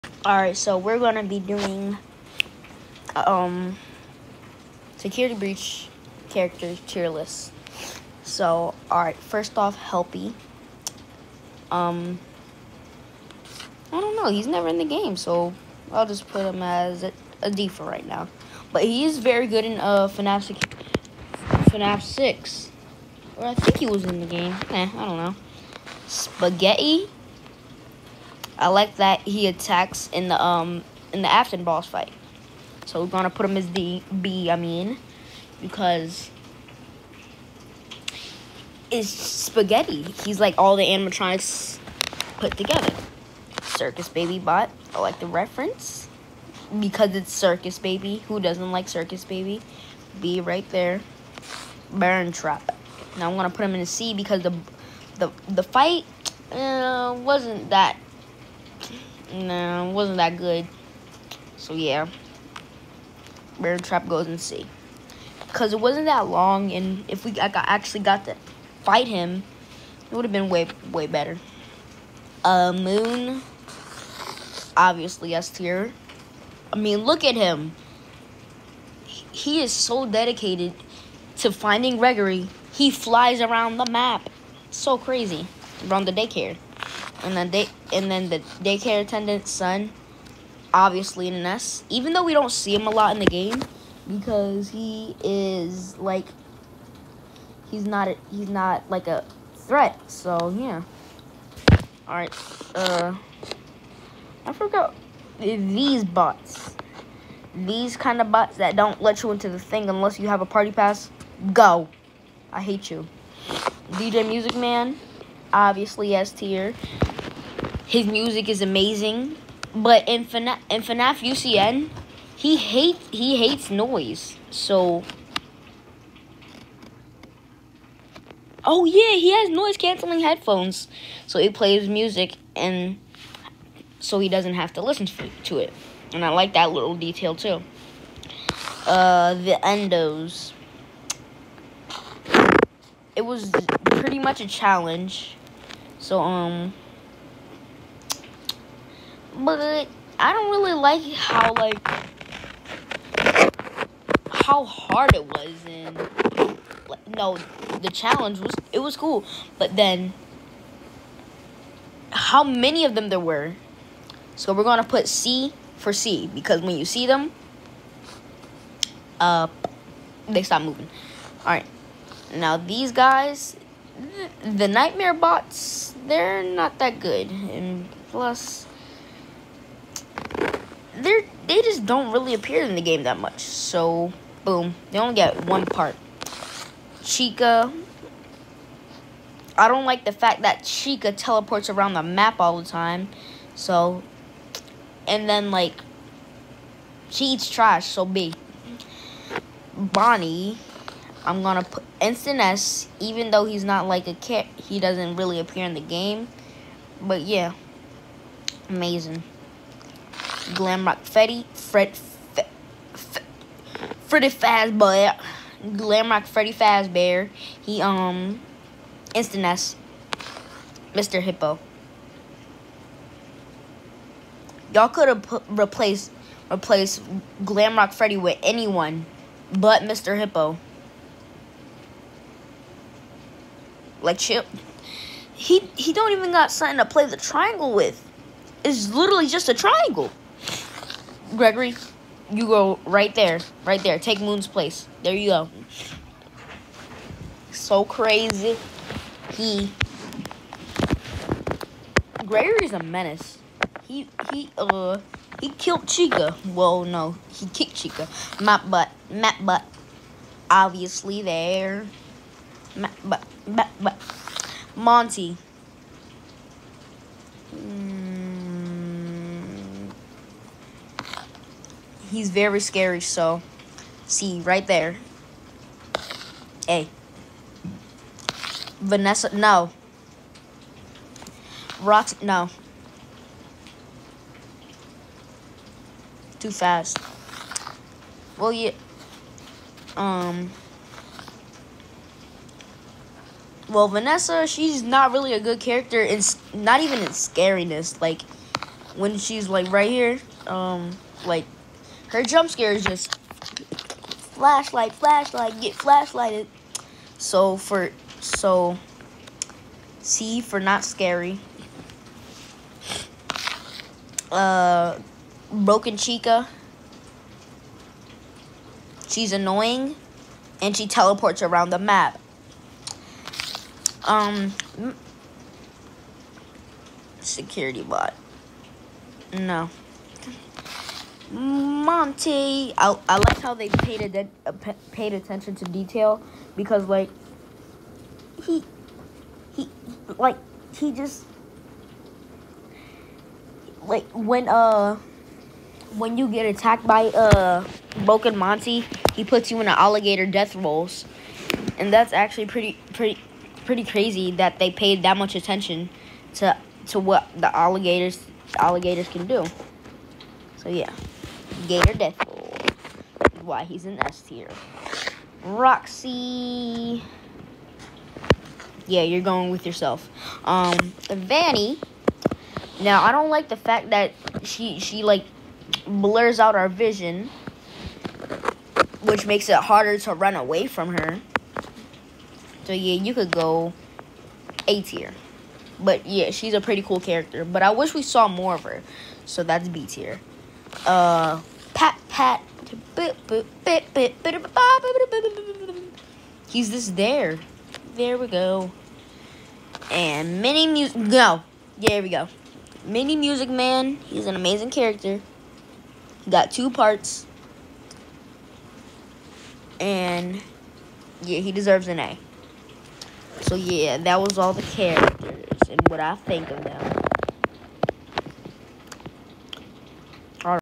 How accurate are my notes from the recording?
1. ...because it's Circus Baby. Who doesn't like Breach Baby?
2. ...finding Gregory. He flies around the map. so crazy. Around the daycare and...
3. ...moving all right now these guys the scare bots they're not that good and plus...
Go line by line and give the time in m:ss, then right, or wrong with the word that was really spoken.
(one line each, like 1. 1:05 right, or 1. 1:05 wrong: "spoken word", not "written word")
1. 0:46 wrong: "Circus", not "Breach"
2. 1:21 right
3. 2:50 wrong: "nightmare", not "scare".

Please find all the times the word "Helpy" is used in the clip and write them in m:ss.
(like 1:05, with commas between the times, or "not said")
0:09.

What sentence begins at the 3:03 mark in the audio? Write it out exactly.
So boom, they only get one part.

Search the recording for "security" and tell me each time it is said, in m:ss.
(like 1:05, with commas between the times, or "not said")
0:04, 5:27.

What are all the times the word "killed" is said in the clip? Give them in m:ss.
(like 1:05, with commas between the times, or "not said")
4:15.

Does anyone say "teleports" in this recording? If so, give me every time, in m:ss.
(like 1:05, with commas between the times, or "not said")
3:11, 5:20.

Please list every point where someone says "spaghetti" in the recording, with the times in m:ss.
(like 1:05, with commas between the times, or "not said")
0:26, 0:39.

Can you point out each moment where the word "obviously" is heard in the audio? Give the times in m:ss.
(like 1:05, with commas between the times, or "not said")
1:14, 1:30, 1:55, 4:20.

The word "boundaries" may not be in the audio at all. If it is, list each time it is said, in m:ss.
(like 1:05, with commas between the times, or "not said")
not said.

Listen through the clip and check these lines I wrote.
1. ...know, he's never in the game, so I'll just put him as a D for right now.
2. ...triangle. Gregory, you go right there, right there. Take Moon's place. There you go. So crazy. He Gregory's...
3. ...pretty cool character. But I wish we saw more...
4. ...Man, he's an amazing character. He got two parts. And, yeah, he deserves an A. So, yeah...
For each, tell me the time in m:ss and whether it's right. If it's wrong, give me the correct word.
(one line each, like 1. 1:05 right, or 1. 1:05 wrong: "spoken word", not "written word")
1. 0:14 right
2. 3:59 right
3. 6:26 right
4. 6:43 right.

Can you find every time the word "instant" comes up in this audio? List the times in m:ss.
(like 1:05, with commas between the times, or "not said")
3:21, 3:39.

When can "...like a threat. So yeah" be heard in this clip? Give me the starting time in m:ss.
1:38.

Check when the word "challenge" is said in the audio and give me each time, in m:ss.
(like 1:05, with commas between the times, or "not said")
2:24, 2:37.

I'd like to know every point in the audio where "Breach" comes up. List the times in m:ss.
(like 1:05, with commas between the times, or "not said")
0:05.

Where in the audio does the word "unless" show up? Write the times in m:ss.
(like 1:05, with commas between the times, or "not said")
1:49.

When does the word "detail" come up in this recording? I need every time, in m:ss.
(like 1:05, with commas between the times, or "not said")
2:16, 5:35.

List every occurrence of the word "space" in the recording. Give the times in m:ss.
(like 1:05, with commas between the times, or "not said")
not said.